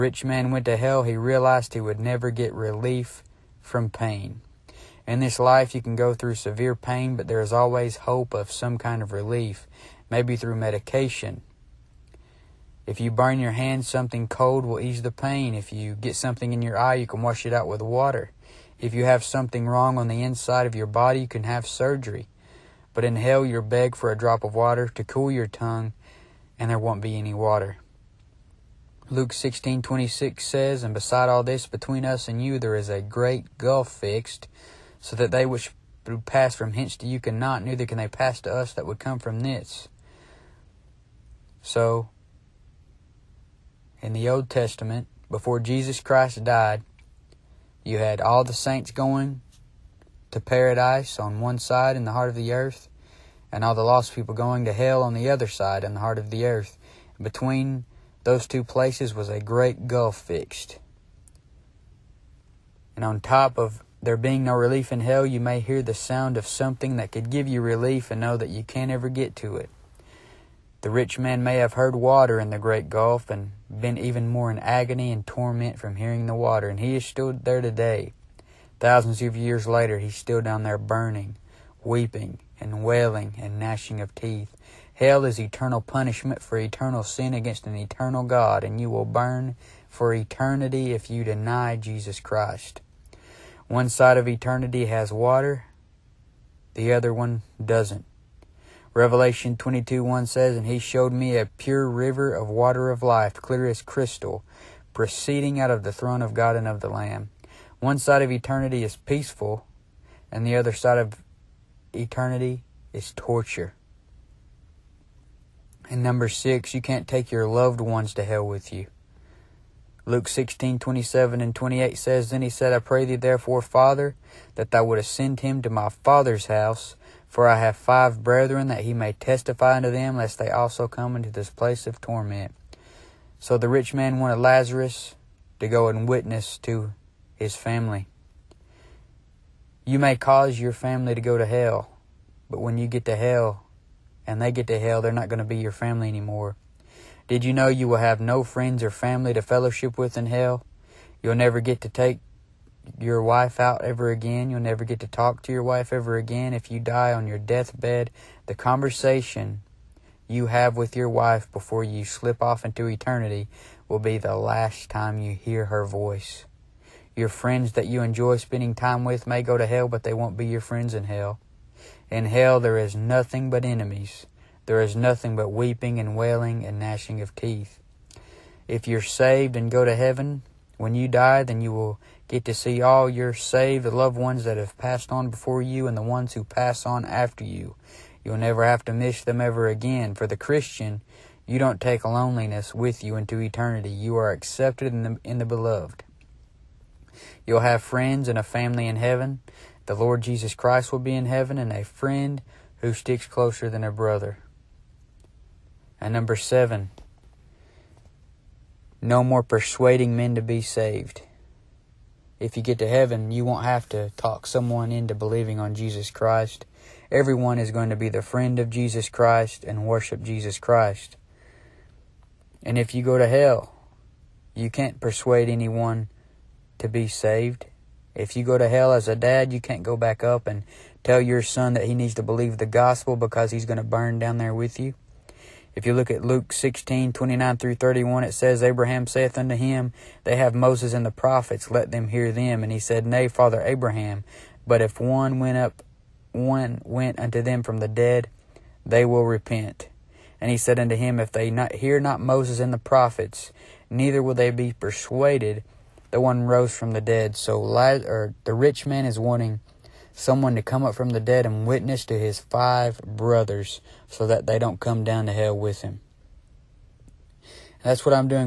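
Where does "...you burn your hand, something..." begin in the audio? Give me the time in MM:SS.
00:13.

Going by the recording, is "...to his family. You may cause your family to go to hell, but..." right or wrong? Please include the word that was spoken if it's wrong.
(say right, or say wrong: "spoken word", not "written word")
right.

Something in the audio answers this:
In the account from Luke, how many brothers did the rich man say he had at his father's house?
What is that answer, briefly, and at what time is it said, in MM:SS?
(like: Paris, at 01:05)
5, at 02:07.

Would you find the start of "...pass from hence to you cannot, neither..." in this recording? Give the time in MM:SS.
00:36.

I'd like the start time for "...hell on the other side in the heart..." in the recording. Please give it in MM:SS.
00:54.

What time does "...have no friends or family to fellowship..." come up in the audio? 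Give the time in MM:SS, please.
02:27.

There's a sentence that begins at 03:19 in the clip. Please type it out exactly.
The Lord Jesus Christ will be in heaven and a friend who sticks closer than a brother.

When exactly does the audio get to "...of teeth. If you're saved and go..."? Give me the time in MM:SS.
02:57.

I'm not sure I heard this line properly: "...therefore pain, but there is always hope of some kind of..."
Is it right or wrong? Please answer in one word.
wrong.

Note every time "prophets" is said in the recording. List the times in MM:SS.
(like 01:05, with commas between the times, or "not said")
04:01, 04:12.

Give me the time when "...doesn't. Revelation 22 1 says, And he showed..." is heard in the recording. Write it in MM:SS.
01:37.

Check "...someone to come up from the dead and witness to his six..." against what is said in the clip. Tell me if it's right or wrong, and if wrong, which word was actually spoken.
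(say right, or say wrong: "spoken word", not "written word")
wrong: "five", not "six".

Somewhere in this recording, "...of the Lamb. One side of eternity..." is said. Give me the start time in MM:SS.
01:46.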